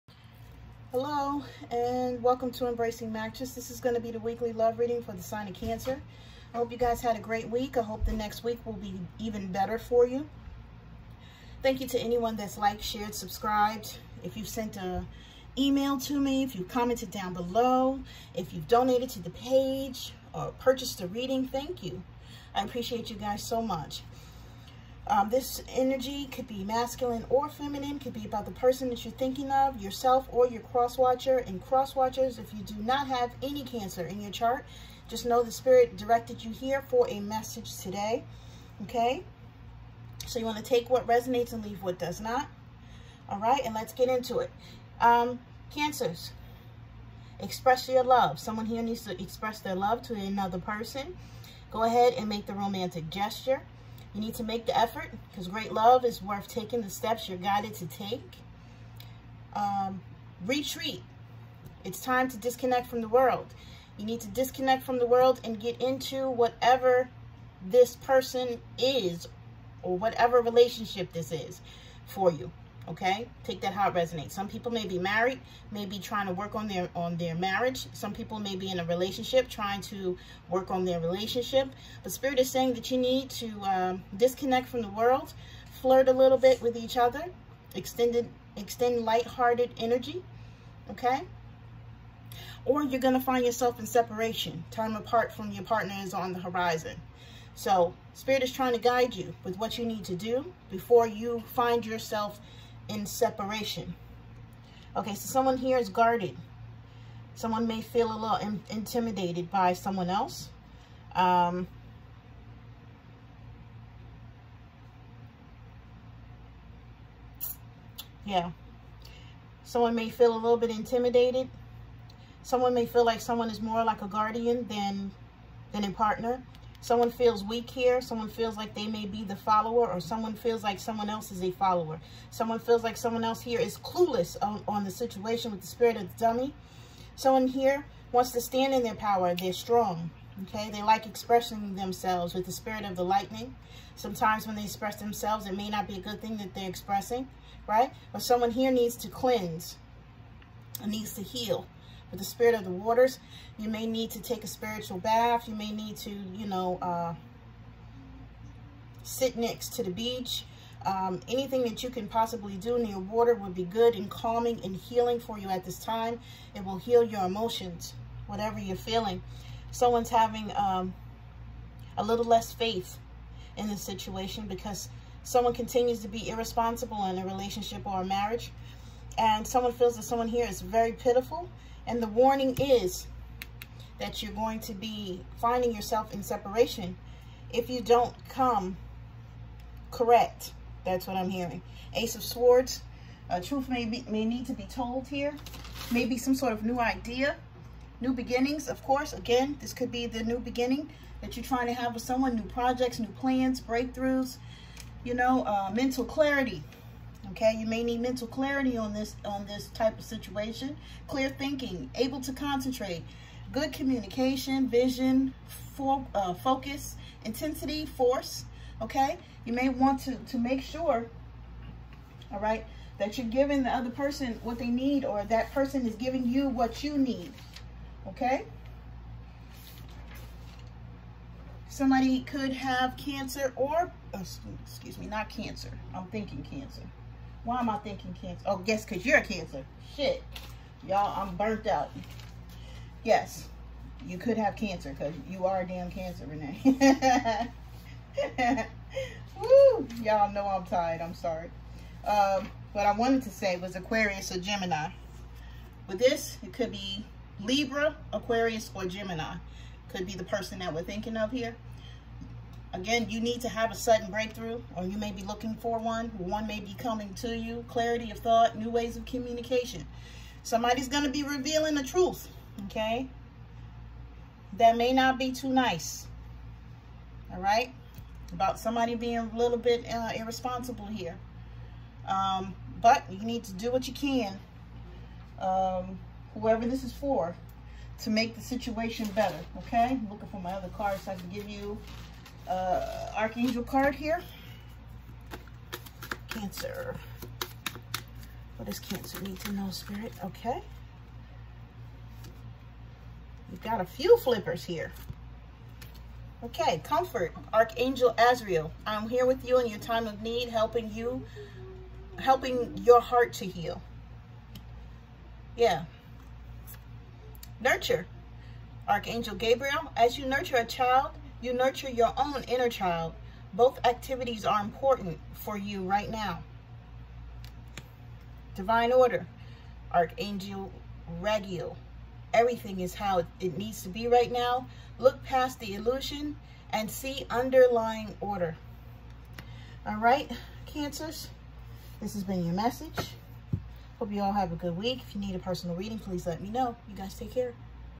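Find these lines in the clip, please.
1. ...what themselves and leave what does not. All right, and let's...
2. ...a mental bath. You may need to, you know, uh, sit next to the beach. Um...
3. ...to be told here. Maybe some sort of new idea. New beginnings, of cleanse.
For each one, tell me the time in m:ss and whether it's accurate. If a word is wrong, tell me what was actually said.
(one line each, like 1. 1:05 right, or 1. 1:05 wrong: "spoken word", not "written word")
1. 0:40 wrong: "resonates", not "themselves"
2. 2:34 wrong: "spiritual", not "mental"
3. 3:14 wrong: "course", not "cleanse".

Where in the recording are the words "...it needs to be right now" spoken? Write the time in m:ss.
5:33.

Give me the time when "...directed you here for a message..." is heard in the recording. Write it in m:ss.
0:35.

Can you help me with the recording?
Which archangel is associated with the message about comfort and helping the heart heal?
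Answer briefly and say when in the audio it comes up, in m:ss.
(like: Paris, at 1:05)
Azrael, at 5:07.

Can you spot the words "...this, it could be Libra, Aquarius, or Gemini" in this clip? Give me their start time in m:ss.
4:15.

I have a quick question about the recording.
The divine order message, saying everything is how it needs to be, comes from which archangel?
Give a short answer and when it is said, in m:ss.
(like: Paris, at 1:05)
Regiel, at 5:29.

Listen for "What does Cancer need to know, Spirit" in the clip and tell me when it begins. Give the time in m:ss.
4:58.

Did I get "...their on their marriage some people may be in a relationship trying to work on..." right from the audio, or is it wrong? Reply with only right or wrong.
right.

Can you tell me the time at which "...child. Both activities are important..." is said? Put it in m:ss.
5:22.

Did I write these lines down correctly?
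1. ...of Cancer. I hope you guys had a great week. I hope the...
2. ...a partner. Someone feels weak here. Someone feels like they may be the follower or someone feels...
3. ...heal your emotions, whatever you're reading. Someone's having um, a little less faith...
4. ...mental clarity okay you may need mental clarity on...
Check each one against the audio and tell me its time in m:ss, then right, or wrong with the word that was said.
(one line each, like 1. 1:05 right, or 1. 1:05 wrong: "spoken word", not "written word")
1. 0:05 right
2. 2:05 right
3. 2:46 wrong: "feeling", not "reading"
4. 3:25 right.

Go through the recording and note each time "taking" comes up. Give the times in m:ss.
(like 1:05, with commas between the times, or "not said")
0:56.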